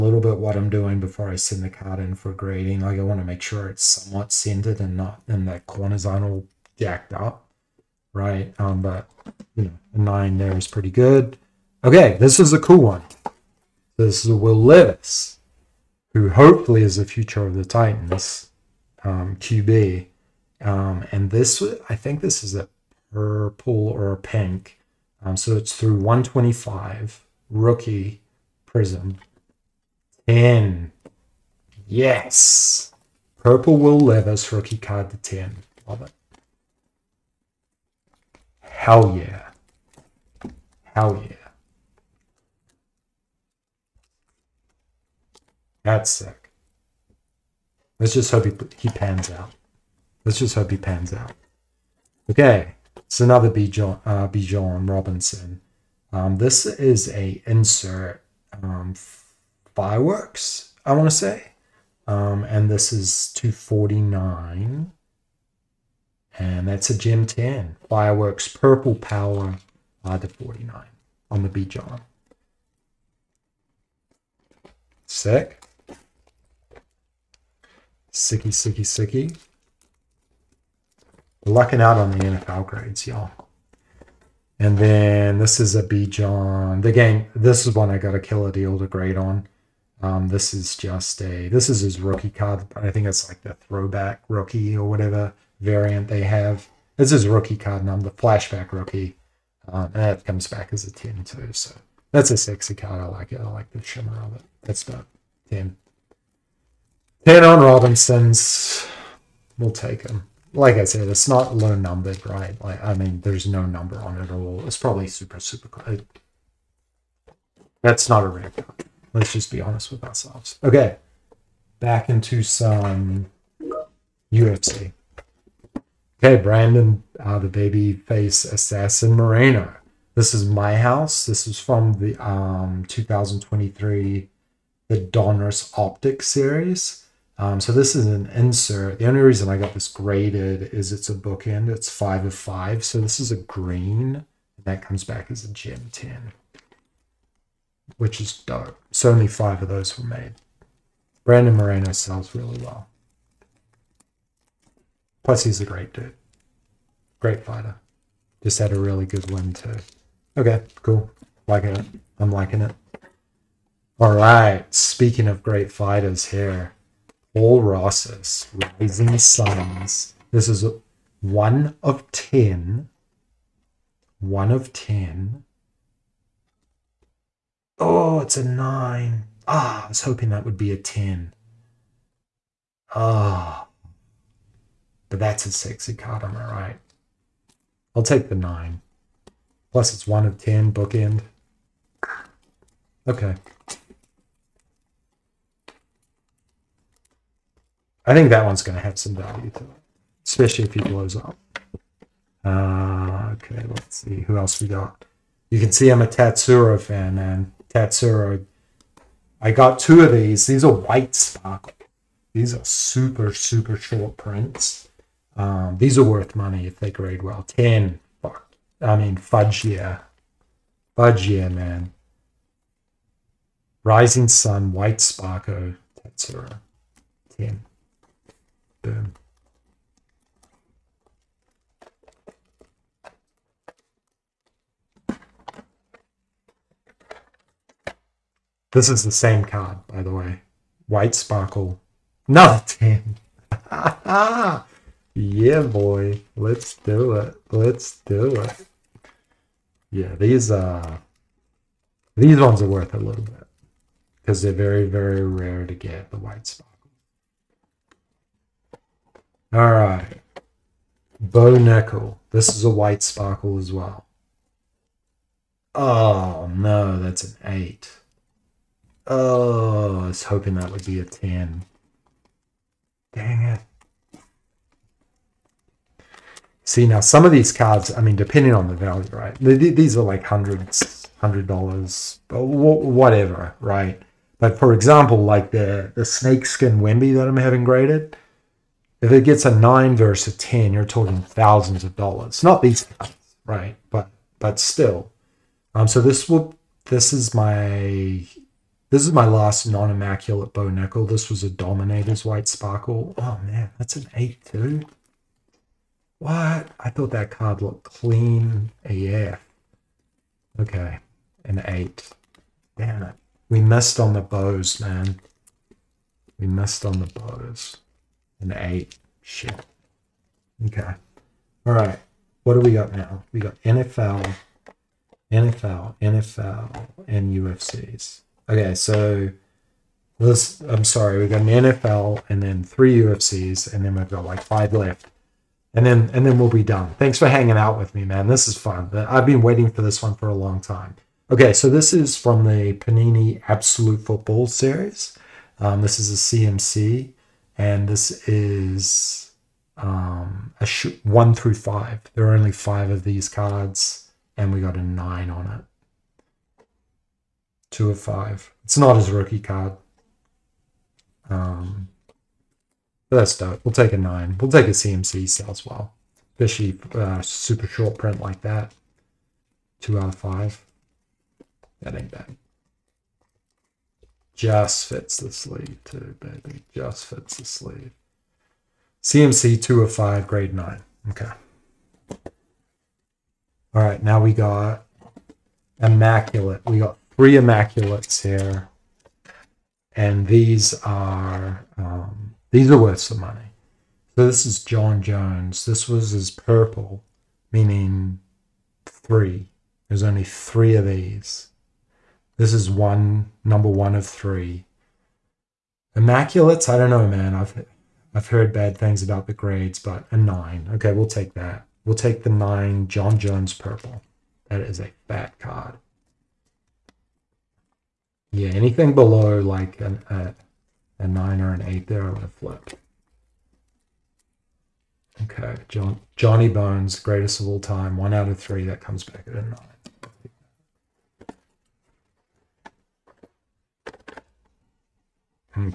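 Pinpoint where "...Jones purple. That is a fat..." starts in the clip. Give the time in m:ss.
6:53.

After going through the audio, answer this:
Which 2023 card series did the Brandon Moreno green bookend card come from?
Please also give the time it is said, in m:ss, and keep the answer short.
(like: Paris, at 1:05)
Donruss Optic, at 2:14.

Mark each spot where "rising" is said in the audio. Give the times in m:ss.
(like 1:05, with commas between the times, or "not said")
2:48, 3:43.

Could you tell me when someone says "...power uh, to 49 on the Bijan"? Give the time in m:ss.
1:08.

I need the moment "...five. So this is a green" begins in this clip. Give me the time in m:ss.
2:22.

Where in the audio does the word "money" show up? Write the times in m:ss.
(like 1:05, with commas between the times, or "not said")
3:36, 6:33.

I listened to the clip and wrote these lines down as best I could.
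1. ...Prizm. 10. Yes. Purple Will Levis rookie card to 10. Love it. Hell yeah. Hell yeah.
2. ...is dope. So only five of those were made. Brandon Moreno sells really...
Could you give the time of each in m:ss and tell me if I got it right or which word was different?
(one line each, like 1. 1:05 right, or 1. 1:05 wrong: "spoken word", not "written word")
1. 0:28 right
2. 2:28 right.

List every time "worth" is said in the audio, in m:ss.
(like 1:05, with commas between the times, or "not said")
3:36, 4:12, 6:32.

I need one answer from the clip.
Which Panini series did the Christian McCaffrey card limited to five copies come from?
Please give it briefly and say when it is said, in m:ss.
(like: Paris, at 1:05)
Panini Absolute Football, at 5:42.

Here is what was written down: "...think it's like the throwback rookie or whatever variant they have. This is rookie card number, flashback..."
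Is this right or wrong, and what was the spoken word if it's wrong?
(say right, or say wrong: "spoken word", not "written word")
right.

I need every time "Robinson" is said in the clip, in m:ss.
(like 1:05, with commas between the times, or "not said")
0:54, 1:47.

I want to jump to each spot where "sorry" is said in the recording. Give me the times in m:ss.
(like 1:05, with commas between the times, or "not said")
5:30.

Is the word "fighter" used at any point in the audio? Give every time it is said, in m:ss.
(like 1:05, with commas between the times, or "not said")
2:37, 2:45.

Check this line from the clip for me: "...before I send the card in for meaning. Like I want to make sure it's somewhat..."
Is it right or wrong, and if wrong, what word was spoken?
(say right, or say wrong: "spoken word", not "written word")
wrong: "grading", not "meaning".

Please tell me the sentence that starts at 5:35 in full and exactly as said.
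And then and then we'll be done.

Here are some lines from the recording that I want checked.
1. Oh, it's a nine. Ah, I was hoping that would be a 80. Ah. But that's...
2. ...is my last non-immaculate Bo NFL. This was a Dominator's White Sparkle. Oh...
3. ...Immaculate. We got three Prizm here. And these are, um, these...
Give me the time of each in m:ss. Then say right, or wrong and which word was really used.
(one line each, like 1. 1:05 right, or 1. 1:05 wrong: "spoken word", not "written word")
1. 2:57 wrong: "10", not "80"
2. 4:59 wrong: "Nickal", not "NFL"
3. 6:25 wrong: "Immaculates", not "Prizm".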